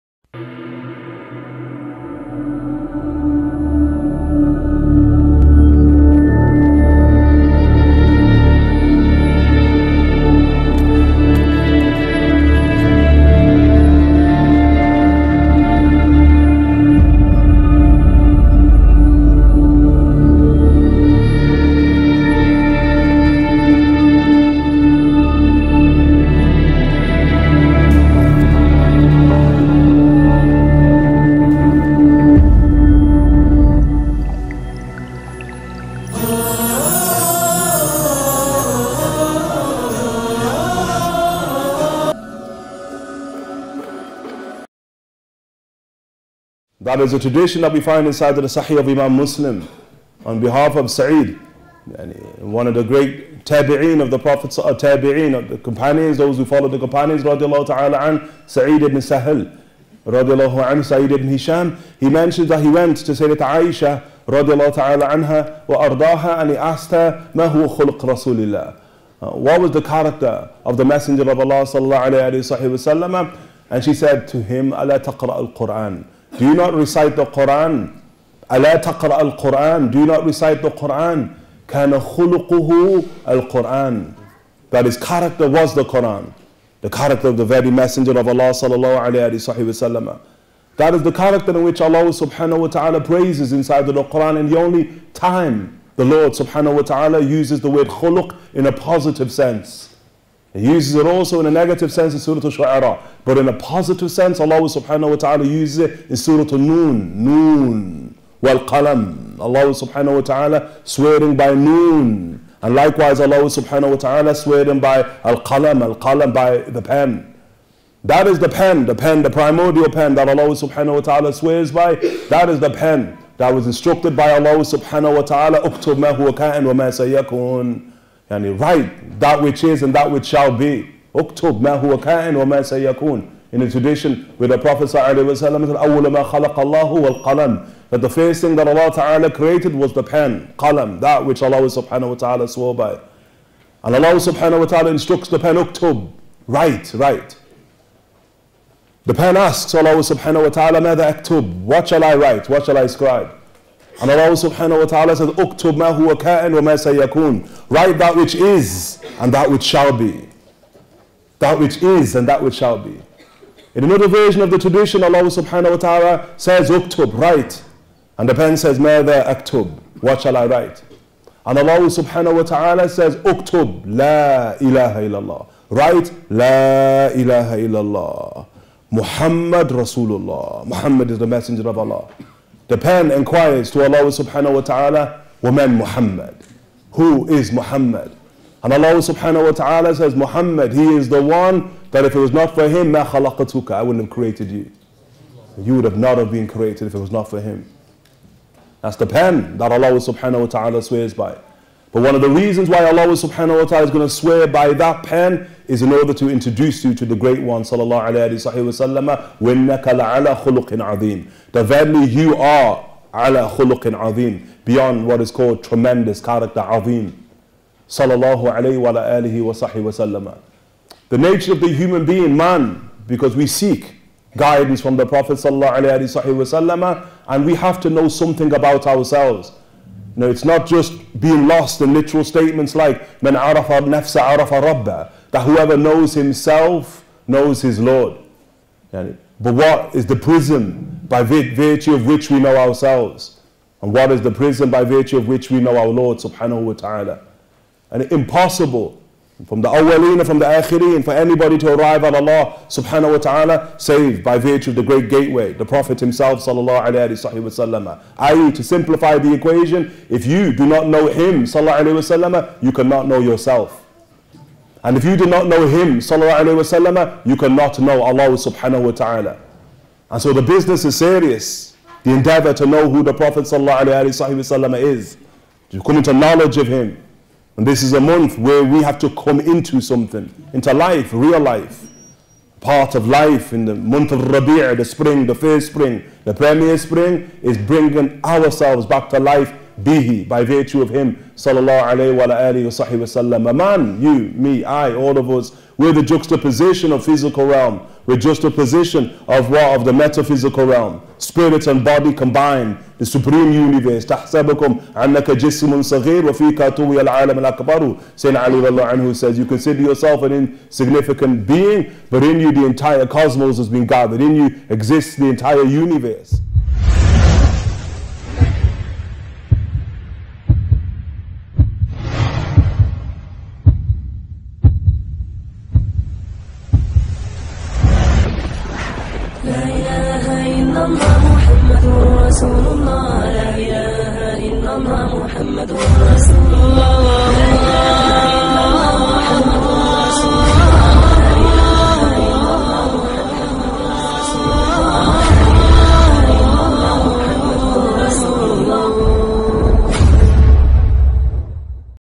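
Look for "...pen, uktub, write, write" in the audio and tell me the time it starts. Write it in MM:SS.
02:25.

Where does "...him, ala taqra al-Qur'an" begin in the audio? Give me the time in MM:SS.
01:14.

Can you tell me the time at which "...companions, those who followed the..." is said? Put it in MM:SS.
00:55.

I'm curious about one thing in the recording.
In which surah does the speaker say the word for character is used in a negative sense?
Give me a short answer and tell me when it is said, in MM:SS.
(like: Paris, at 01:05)
Surah Al-Shu'ara, at 01:42.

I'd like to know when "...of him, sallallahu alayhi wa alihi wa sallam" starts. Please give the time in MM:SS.
04:50.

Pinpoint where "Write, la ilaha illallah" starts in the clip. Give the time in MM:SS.
02:55.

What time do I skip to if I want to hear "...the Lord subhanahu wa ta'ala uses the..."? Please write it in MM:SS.
01:35.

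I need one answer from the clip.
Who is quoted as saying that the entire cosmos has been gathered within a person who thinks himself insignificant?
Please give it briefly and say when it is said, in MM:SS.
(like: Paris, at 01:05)
Sayyidina Ali, at 05:08.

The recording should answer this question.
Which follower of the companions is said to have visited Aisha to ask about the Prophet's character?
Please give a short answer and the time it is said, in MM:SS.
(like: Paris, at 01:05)
Sa'id ibn Hisham, at 01:00.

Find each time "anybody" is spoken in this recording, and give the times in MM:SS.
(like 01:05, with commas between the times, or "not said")
04:11.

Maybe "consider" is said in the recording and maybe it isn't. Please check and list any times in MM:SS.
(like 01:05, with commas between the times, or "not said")
05:09.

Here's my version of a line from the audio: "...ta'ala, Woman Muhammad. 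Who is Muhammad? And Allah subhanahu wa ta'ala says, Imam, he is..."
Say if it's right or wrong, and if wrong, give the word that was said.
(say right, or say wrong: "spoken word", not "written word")
wrong: "Muhammad", not "Imam".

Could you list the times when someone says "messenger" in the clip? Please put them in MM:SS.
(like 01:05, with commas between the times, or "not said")
01:10, 01:27, 03:01.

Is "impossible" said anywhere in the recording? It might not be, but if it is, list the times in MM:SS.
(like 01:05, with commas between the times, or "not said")
04:08.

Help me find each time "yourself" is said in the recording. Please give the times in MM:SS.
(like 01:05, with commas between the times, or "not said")
04:23, 05:09.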